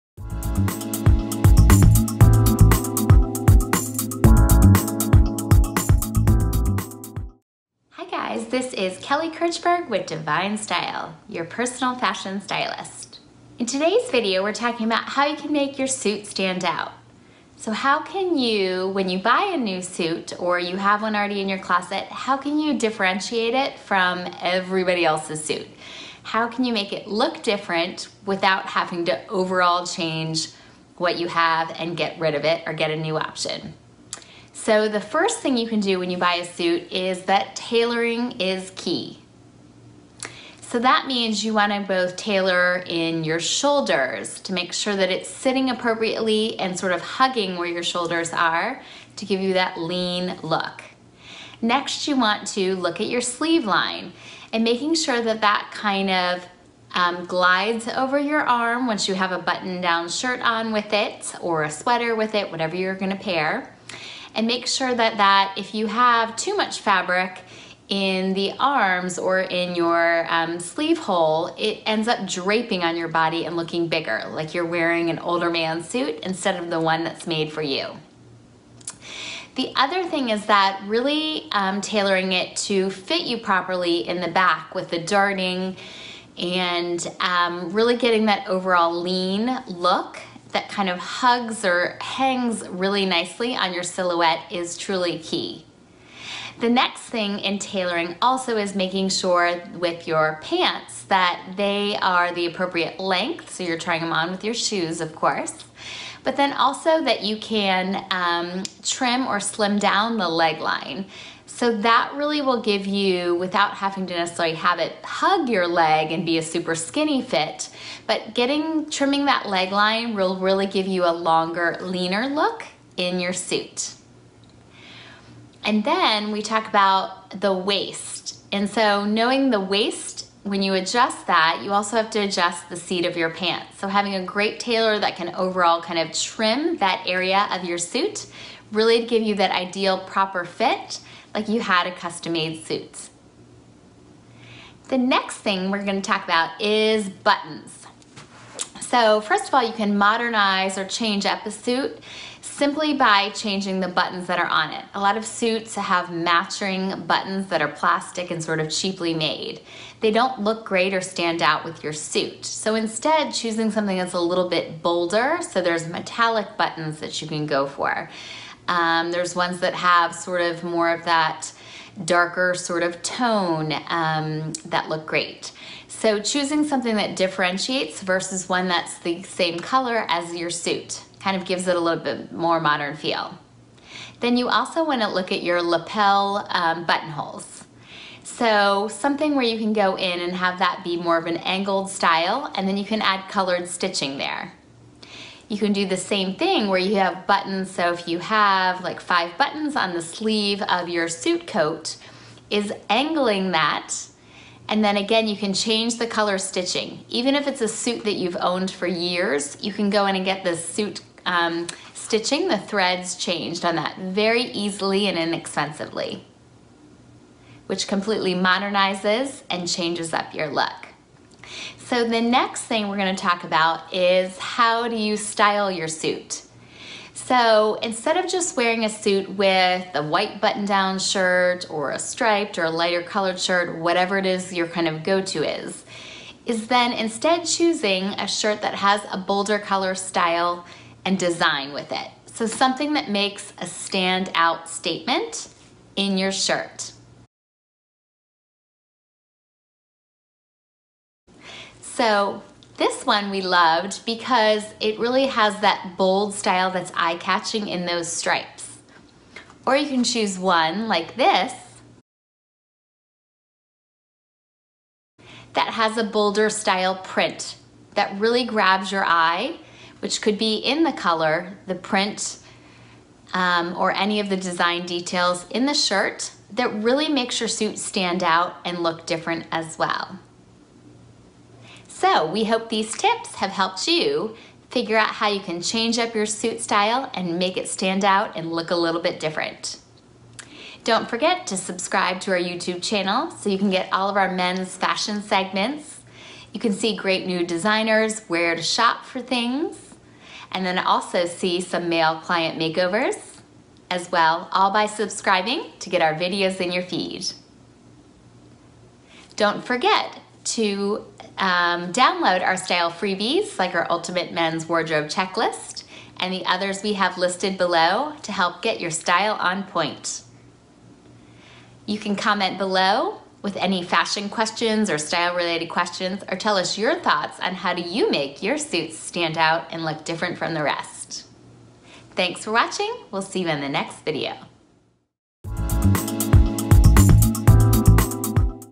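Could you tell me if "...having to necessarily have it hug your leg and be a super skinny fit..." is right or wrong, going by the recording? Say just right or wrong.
right.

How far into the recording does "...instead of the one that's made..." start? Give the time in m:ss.
1:16.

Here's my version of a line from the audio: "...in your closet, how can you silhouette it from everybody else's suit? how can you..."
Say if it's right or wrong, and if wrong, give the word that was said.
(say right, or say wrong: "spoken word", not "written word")
wrong: "differentiate", not "silhouette".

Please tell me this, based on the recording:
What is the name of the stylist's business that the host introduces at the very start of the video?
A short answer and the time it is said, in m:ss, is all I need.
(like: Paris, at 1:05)
Divine Style, at 0:10.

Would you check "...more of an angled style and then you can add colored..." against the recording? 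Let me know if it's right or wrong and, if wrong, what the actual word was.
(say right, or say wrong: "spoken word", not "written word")
right.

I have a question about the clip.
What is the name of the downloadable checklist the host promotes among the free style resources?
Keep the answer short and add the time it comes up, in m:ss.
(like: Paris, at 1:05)
Ultimate Men's Wardrobe Checklist, at 5:13.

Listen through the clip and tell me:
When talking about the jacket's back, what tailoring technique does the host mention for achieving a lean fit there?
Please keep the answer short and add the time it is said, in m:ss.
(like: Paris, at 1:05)
darting, at 1:24.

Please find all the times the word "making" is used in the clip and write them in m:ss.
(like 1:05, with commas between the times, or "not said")
0:54, 1:38.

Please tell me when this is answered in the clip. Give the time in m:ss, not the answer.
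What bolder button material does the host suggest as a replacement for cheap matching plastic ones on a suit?
2:45.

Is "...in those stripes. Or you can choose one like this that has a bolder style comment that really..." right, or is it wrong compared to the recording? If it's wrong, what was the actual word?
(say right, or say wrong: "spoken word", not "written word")
wrong: "print", not "comment".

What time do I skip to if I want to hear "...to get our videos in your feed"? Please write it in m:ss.
5:05.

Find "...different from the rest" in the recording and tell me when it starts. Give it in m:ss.
5:30.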